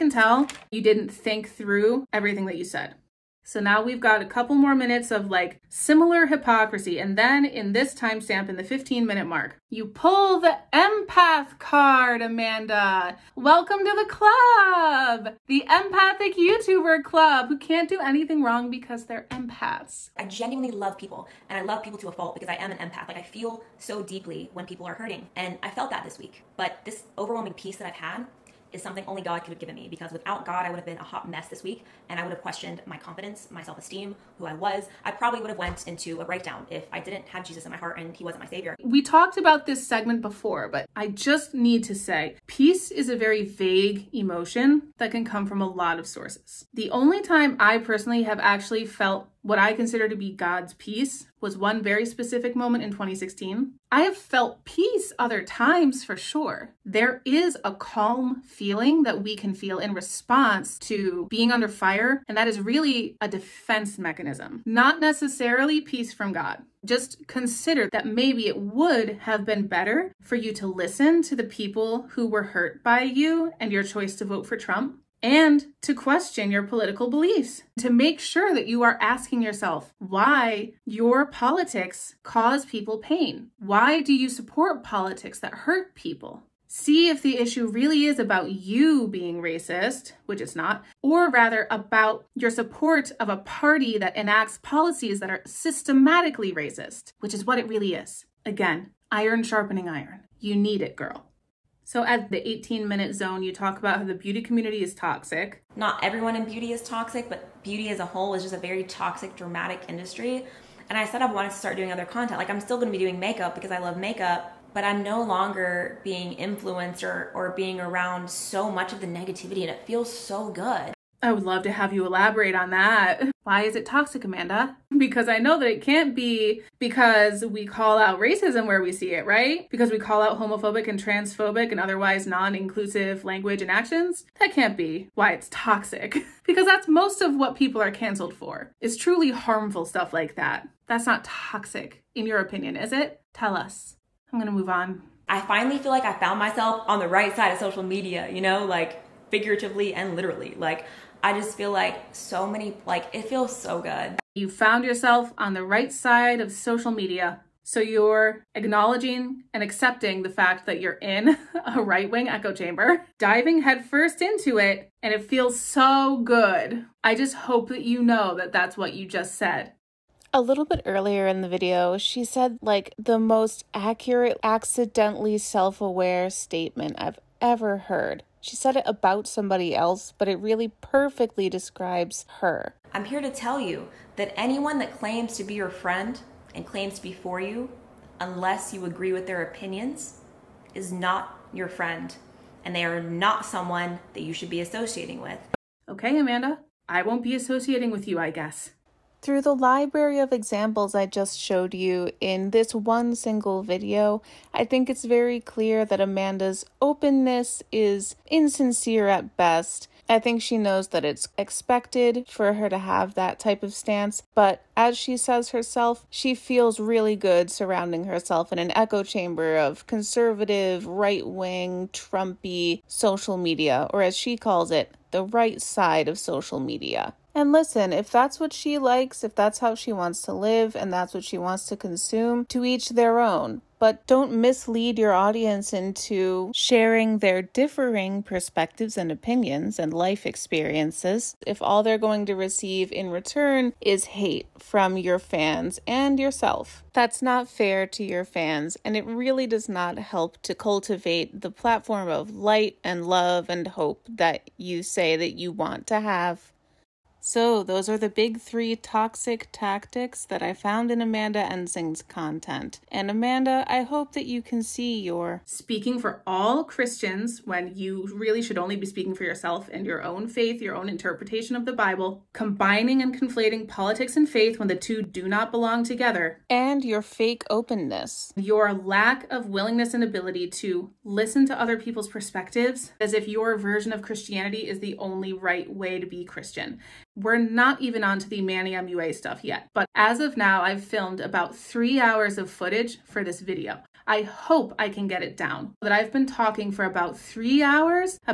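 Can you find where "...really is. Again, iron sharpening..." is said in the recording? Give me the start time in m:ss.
1:37.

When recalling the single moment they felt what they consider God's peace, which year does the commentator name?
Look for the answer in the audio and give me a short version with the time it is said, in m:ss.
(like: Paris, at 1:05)
2016, at 0:52.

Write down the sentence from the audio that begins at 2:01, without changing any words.
I would love to have you elaborate on that.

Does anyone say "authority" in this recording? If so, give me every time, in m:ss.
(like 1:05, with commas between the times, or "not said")
not said.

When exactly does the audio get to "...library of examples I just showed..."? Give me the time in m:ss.
3:19.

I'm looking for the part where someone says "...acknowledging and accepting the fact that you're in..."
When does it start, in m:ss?
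2:38.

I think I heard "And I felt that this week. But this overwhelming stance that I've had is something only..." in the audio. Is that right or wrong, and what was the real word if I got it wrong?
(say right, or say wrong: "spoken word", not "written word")
wrong: "peace", not "stance".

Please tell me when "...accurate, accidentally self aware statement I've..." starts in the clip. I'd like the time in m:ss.
2:53.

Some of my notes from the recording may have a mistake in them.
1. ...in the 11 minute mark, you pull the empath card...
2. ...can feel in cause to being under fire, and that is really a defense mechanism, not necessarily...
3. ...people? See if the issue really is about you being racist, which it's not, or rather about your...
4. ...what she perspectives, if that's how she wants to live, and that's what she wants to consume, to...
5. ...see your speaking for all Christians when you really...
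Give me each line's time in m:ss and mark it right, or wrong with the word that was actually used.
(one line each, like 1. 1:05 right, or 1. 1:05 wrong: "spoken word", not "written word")
1. 0:08 wrong: "15", not "11"
2. 0:59 wrong: "response", not "cause"
3. 1:25 right
4. 3:48 wrong: "likes", not "perspectives"
5. 4:24 right.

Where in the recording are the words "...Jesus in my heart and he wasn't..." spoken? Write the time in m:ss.
0:37.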